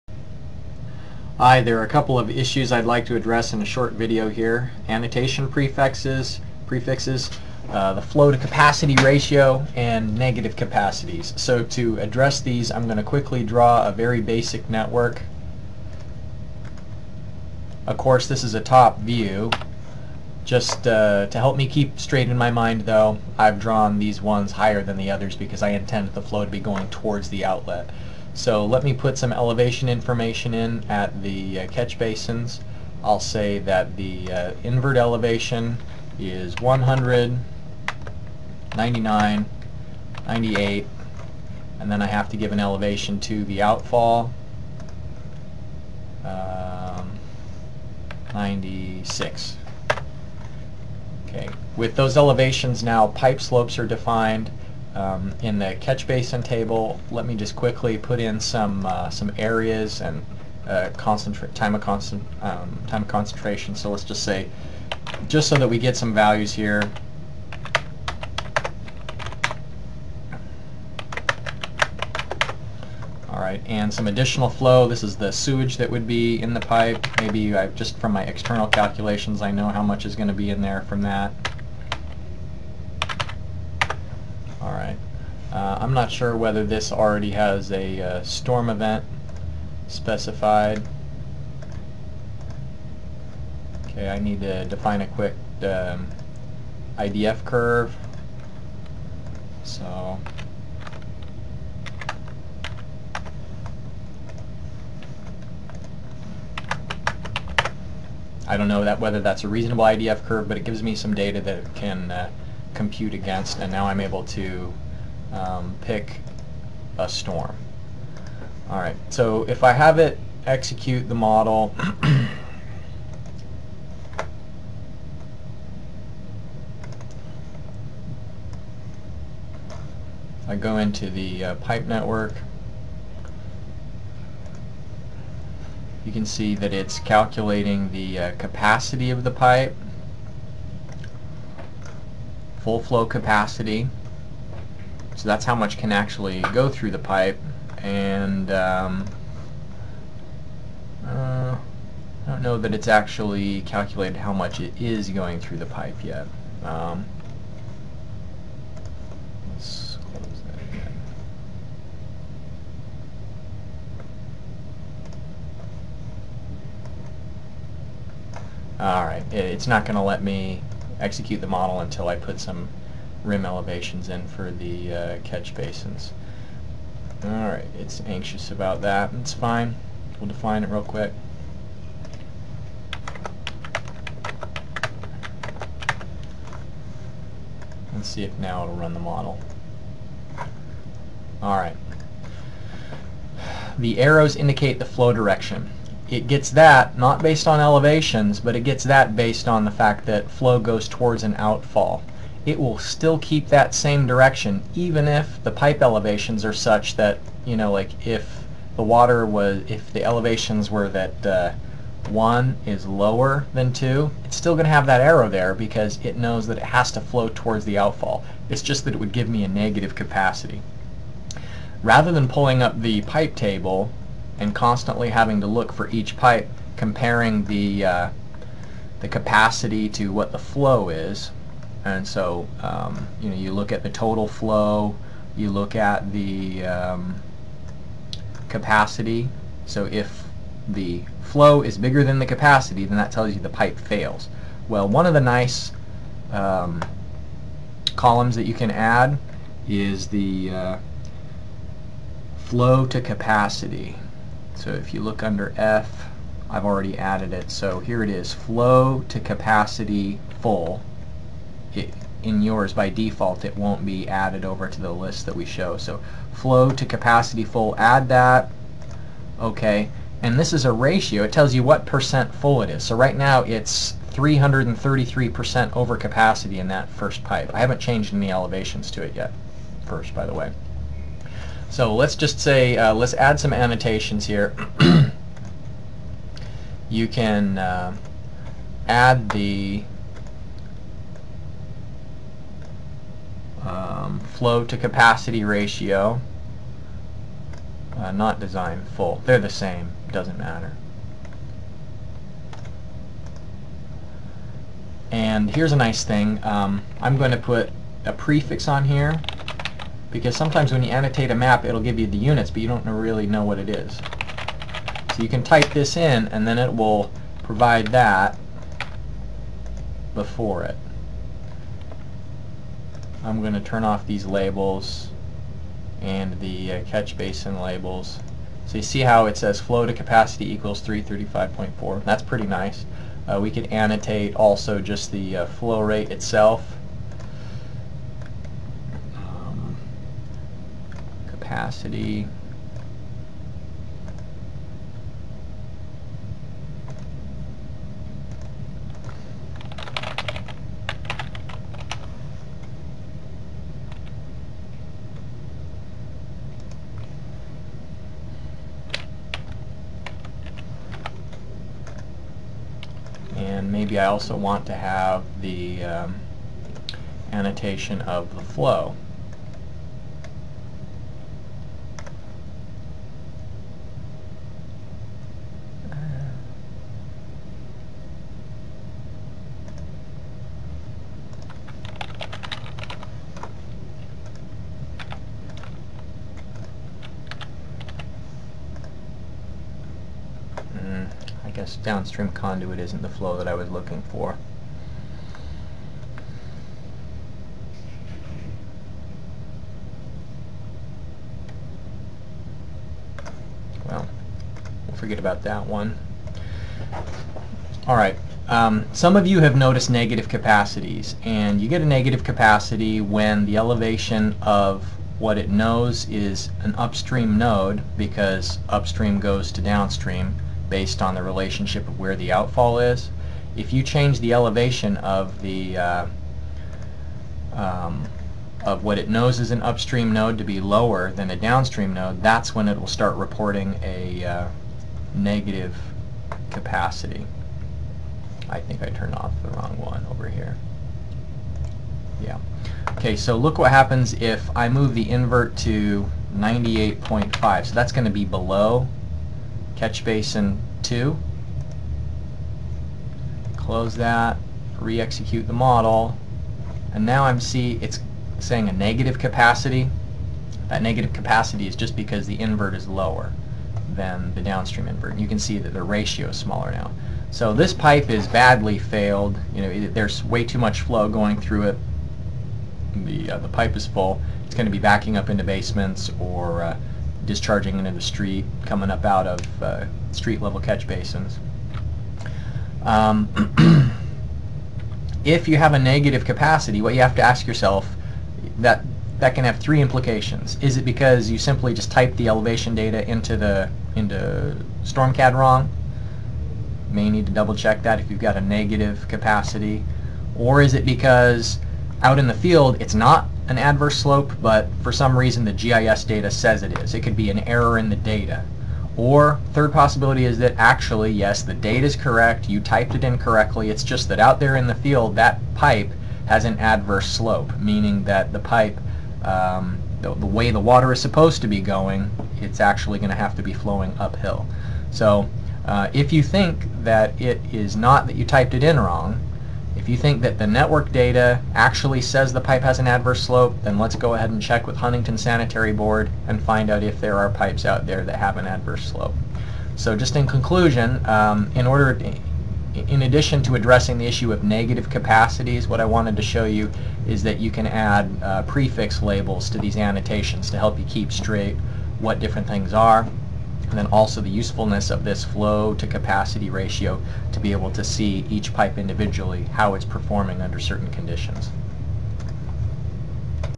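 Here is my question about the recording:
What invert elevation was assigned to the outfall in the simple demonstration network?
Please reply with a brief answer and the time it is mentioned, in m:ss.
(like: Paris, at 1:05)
96, at 0:48.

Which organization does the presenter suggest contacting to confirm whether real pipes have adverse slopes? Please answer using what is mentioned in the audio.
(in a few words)
Huntington Sanitary Board.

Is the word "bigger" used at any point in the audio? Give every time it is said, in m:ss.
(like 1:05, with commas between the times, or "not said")
4:01.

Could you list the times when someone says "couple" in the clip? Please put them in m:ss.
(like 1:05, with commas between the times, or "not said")
0:01.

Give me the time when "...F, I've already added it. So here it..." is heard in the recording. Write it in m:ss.
4:15.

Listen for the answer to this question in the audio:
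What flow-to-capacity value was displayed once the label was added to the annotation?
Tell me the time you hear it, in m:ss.
5:30.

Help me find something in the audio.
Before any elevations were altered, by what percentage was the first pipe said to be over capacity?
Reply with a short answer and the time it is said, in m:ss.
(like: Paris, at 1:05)
333%, at 4:34.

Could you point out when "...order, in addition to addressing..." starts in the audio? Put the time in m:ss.
9:01.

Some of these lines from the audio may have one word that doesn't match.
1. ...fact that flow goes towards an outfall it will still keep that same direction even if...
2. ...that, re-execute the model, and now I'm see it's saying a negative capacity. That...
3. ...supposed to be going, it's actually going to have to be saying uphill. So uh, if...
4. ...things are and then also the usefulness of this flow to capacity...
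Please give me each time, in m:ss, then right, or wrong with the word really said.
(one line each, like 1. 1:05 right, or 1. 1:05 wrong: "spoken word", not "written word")
1. 3:19 right
2. 7:33 right
3. 8:41 wrong: "flowing", not "saying"
4. 9:12 right.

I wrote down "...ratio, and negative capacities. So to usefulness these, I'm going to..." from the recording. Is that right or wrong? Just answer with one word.
wrong.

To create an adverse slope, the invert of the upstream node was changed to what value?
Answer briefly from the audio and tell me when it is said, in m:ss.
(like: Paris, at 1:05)
98.5, at 7:26.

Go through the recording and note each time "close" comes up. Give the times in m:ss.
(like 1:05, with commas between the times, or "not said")
2:40, 7:33.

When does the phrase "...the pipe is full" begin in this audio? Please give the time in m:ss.
7:53.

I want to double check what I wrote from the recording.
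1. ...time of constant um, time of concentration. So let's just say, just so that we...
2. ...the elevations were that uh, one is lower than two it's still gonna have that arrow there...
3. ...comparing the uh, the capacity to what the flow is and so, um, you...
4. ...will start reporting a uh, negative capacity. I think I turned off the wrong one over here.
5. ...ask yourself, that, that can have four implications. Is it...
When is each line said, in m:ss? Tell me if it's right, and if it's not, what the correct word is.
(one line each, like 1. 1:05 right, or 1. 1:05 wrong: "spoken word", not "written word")
1. 1:00 right
2. 3:29 right
3. 3:46 right
4. 7:12 right
5. 8:07 wrong: "three", not "four".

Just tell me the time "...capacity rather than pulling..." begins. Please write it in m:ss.
3:39.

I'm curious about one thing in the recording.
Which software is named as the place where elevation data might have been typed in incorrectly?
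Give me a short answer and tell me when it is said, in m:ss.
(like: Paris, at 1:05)
StormCAD, at 8:14.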